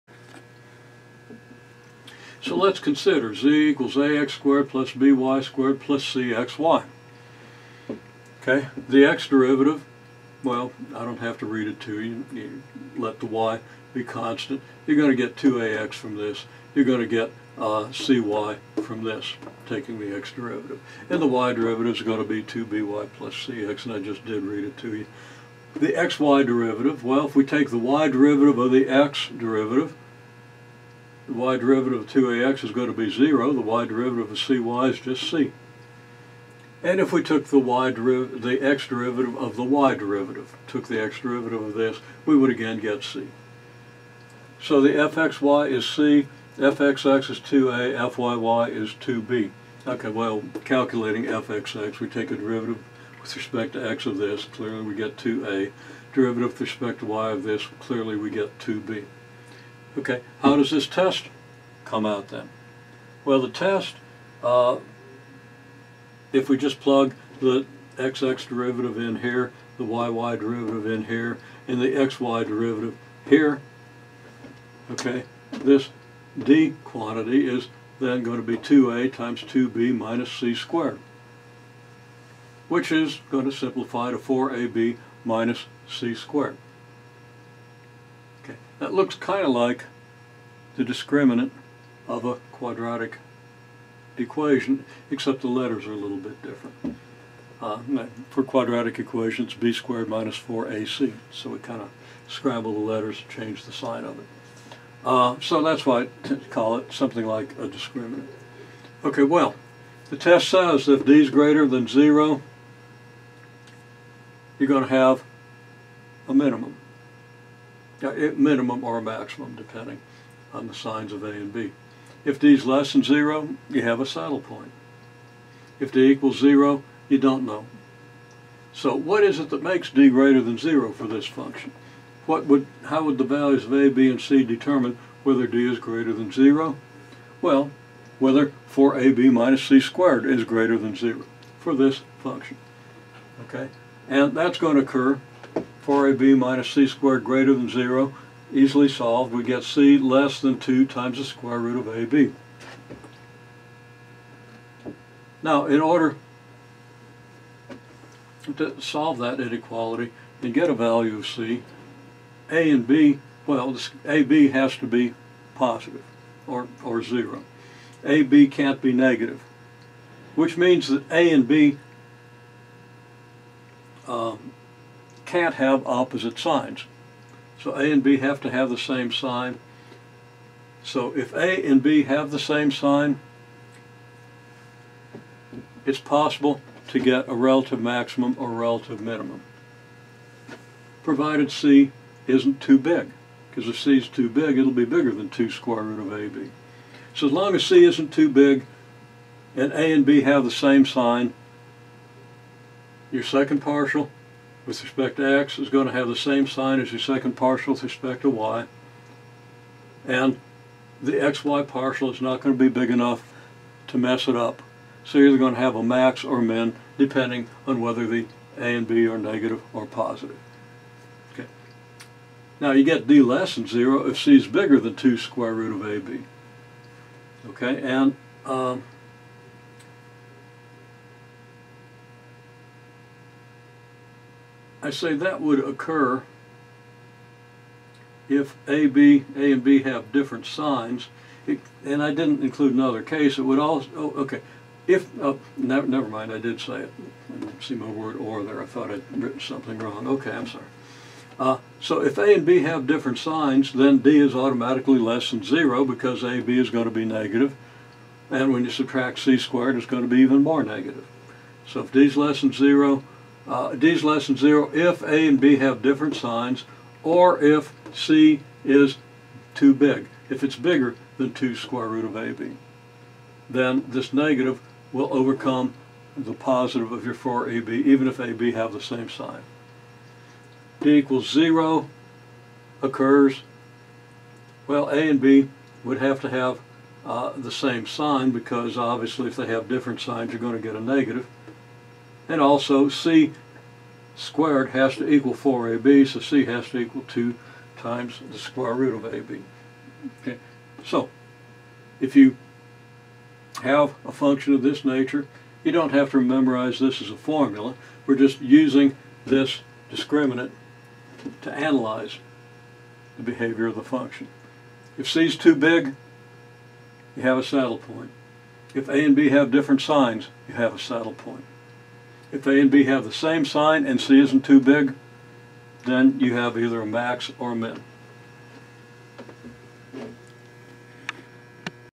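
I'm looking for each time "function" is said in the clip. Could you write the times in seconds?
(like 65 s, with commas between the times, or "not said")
131 s, 142 s, 304 s, 313 s.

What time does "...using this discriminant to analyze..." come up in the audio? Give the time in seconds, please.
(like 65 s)
308 s.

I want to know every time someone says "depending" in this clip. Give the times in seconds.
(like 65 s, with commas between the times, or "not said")
119 s, 216 s.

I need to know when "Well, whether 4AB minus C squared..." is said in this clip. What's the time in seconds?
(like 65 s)
137 s.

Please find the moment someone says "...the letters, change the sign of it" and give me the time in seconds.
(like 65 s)
102 s.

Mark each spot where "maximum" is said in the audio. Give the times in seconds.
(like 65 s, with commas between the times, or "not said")
119 s, 187 s.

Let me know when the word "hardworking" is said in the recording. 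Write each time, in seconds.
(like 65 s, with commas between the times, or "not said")
not said.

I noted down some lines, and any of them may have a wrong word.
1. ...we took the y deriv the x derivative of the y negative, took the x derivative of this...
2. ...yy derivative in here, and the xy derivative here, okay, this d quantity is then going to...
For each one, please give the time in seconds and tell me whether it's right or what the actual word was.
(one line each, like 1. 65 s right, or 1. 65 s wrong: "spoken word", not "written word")
1. 37 s wrong: "derivative", not "negative"
2. 69 s right.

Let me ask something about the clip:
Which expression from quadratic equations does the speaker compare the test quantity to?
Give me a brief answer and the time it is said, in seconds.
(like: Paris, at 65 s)
b^2 - 4ac, at 99 s.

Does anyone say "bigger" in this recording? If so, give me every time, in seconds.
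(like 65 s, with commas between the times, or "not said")
194 s, 224 s, 270 s.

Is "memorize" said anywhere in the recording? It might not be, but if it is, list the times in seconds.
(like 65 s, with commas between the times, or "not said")
306 s.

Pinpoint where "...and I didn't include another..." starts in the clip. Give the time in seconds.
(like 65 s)
241 s.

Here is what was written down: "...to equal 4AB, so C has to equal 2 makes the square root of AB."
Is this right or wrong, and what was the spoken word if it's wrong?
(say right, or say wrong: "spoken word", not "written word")
wrong: "times", not "makes".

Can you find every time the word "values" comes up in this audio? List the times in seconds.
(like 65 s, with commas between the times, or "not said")
133 s, 160 s.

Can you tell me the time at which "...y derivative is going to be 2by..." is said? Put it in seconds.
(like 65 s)
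21 s.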